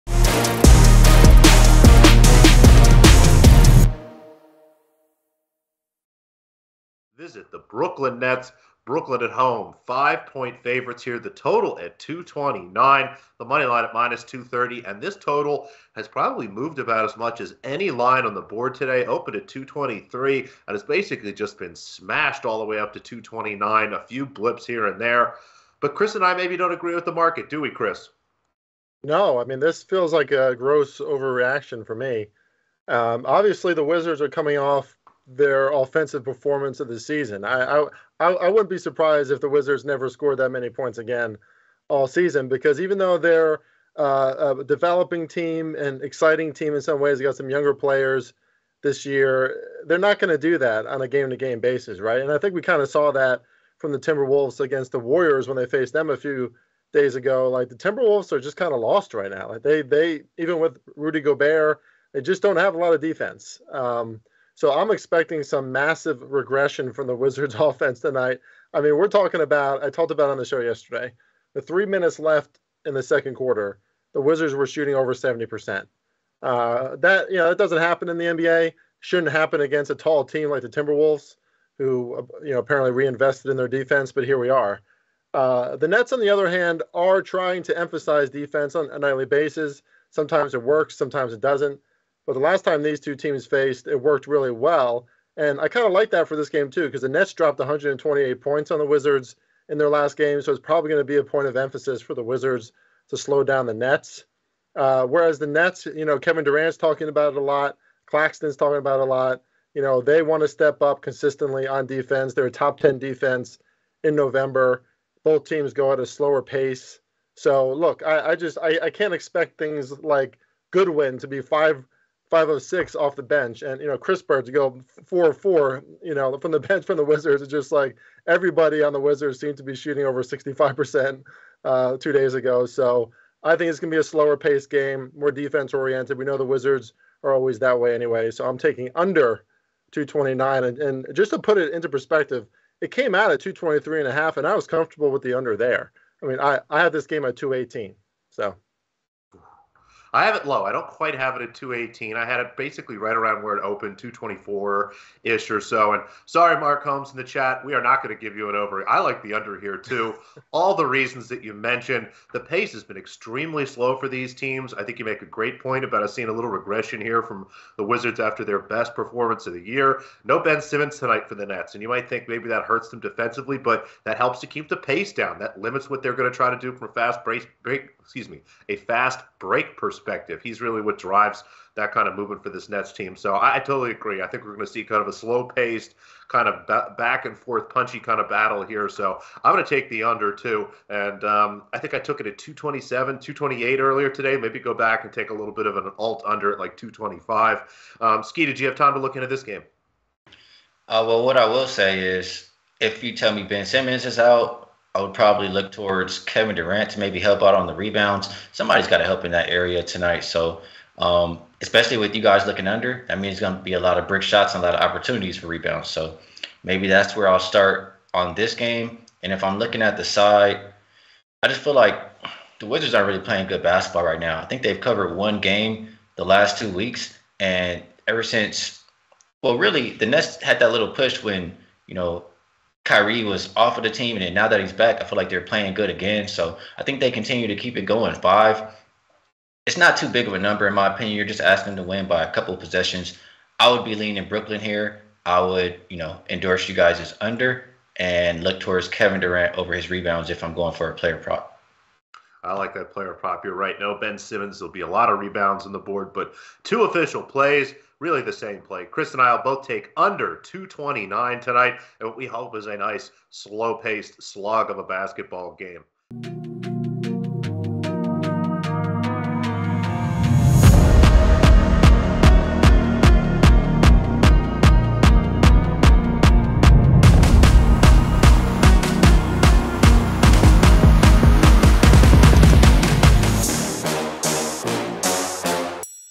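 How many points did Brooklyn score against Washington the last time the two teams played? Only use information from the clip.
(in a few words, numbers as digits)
128.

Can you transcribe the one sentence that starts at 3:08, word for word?
So I'm going to take the under too.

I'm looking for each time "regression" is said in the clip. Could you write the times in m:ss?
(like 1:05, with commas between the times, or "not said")
1:06, 2:46.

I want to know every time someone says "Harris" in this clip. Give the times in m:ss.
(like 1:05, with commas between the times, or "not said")
not said.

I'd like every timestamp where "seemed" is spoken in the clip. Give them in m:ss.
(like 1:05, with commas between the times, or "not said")
2:09.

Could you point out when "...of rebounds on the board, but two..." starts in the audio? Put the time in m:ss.
4:15.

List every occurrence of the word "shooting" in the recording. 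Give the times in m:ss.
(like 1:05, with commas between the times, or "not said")
1:14, 2:09.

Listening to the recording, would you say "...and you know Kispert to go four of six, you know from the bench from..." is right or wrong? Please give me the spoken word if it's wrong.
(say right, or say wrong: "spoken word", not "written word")
wrong: "four", not "six".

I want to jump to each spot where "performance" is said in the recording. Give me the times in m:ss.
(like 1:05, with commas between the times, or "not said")
0:36, 2:48.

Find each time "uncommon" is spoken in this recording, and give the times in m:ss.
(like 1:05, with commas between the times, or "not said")
not said.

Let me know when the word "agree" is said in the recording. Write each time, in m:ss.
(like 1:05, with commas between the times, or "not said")
0:26, 3:03.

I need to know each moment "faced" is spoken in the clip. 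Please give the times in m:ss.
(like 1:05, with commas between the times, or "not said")
0:55, 1:33.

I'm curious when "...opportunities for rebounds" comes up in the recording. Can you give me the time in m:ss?
3:34.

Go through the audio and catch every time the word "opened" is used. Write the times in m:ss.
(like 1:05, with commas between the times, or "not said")
0:19, 2:33.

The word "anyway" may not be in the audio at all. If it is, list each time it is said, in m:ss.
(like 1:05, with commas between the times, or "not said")
2:17.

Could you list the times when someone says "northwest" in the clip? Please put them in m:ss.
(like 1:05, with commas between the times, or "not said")
not said.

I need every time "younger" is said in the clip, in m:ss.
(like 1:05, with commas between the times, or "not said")
0:47.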